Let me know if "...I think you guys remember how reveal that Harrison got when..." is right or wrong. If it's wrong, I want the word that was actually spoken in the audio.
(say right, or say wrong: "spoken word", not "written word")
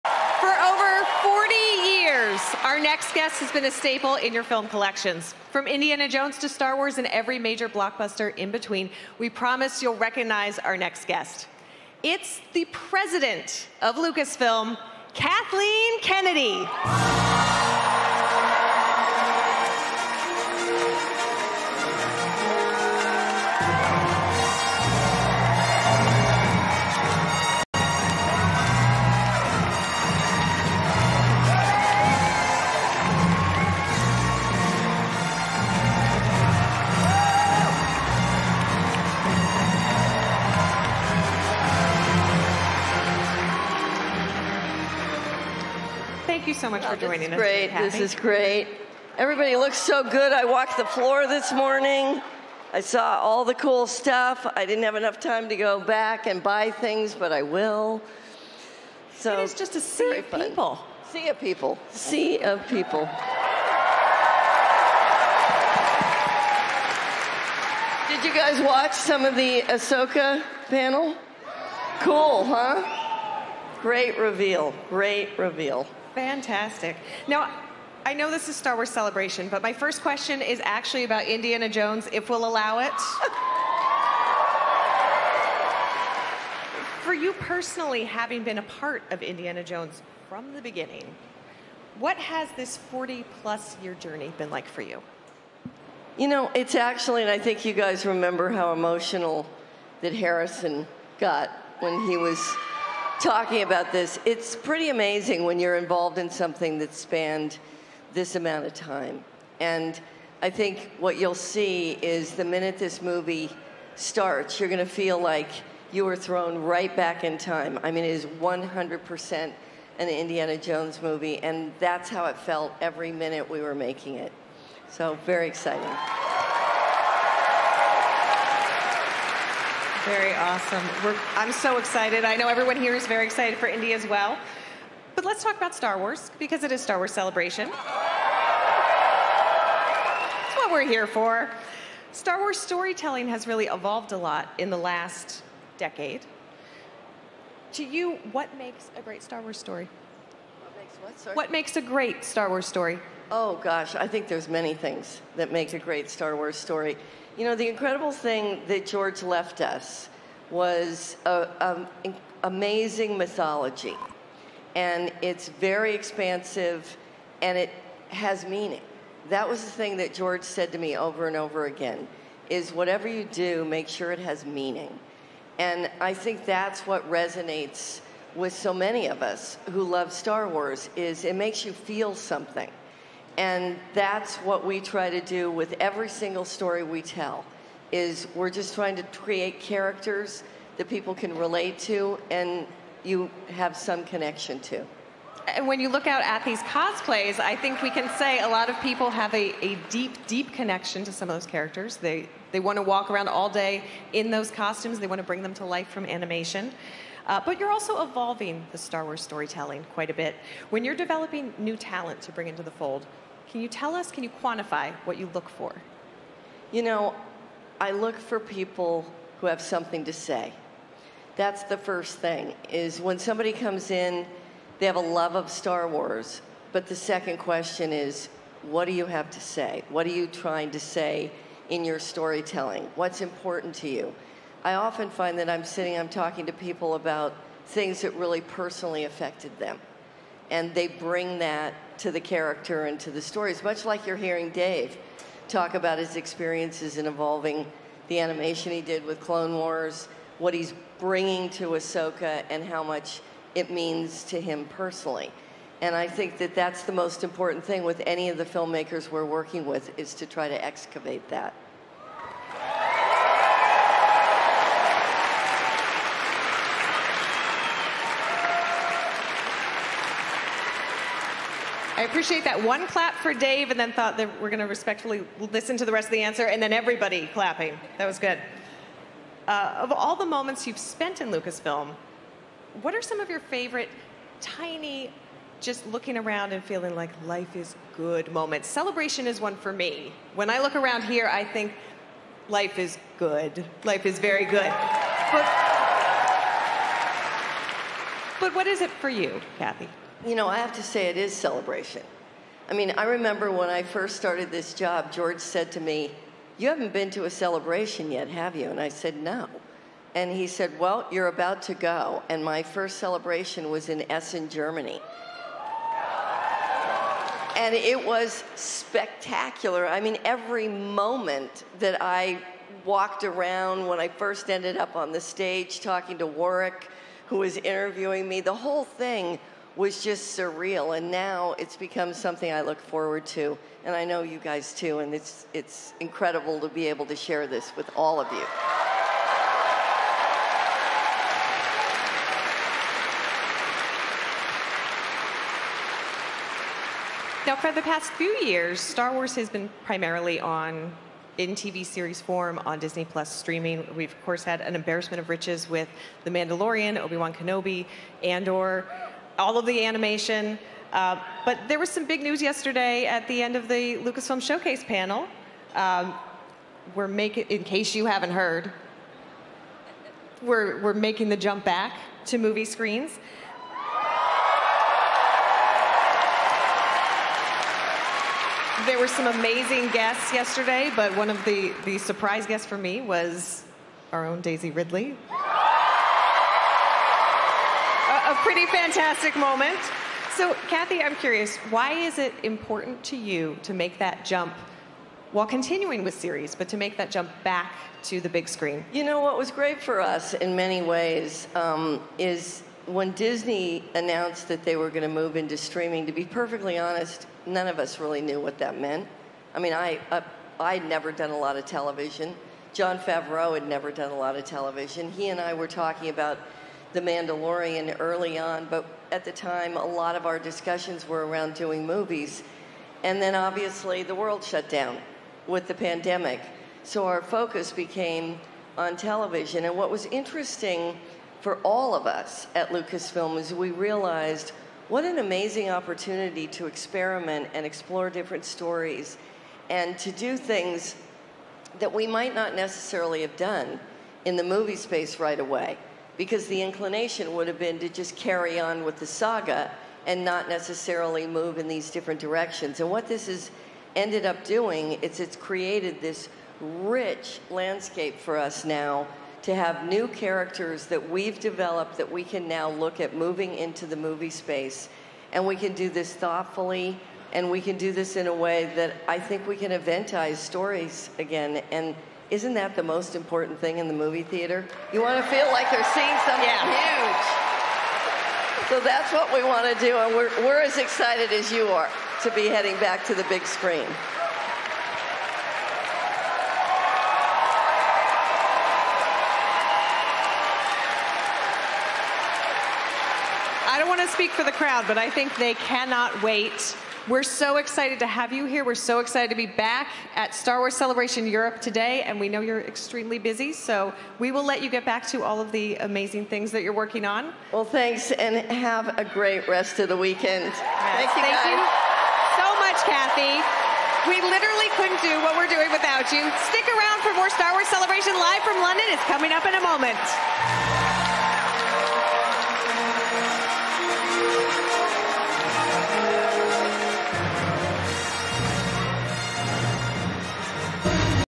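wrong: "emotional", not "reveal".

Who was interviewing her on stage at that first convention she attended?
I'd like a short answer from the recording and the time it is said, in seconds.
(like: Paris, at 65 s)
Warwick, at 326 s.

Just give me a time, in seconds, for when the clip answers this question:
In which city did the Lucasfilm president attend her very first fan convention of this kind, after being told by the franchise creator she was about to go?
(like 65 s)
314 s.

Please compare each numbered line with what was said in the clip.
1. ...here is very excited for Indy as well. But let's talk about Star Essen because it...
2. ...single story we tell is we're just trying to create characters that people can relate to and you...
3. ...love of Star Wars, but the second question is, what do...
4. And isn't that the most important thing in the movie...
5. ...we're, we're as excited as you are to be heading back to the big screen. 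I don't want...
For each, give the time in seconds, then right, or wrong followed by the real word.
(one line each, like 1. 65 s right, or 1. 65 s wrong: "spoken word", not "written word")
1. 132 s wrong: "Wars", not "Essen"
2. 186 s right
3. 224 s right
4. 471 s right
5. 480 s right.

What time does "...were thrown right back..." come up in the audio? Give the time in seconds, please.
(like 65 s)
116 s.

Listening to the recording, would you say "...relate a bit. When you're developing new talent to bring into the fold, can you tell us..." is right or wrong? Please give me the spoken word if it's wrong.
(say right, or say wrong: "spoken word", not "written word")
wrong: "quite", not "relate".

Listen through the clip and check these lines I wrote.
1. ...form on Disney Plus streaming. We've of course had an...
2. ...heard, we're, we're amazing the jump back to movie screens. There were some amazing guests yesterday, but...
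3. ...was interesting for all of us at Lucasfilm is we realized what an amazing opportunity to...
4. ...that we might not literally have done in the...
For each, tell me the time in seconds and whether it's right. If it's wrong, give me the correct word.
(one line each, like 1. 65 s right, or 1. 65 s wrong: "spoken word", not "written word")
1. 352 s right
2. 368 s wrong: "making", not "amazing"
3. 429 s right
4. 441 s wrong: "necessarily", not "literally".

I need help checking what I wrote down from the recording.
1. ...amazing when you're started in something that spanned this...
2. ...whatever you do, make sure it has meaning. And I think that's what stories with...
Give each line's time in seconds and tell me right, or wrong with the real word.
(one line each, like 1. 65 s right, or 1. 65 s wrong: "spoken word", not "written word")
1. 104 s wrong: "involved", not "started"
2. 172 s wrong: "resonates", not "stories".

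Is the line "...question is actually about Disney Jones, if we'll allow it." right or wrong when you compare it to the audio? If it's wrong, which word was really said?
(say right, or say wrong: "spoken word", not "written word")
wrong: "Indiana", not "Disney".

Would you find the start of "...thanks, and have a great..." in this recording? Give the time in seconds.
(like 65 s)
507 s.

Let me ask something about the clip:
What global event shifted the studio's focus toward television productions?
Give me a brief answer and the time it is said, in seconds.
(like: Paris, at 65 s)
The pandemic, at 425 s.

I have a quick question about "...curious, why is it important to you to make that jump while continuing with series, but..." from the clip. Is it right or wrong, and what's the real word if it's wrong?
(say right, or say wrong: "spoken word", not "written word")
right.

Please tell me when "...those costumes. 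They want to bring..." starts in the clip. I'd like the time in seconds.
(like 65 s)
204 s.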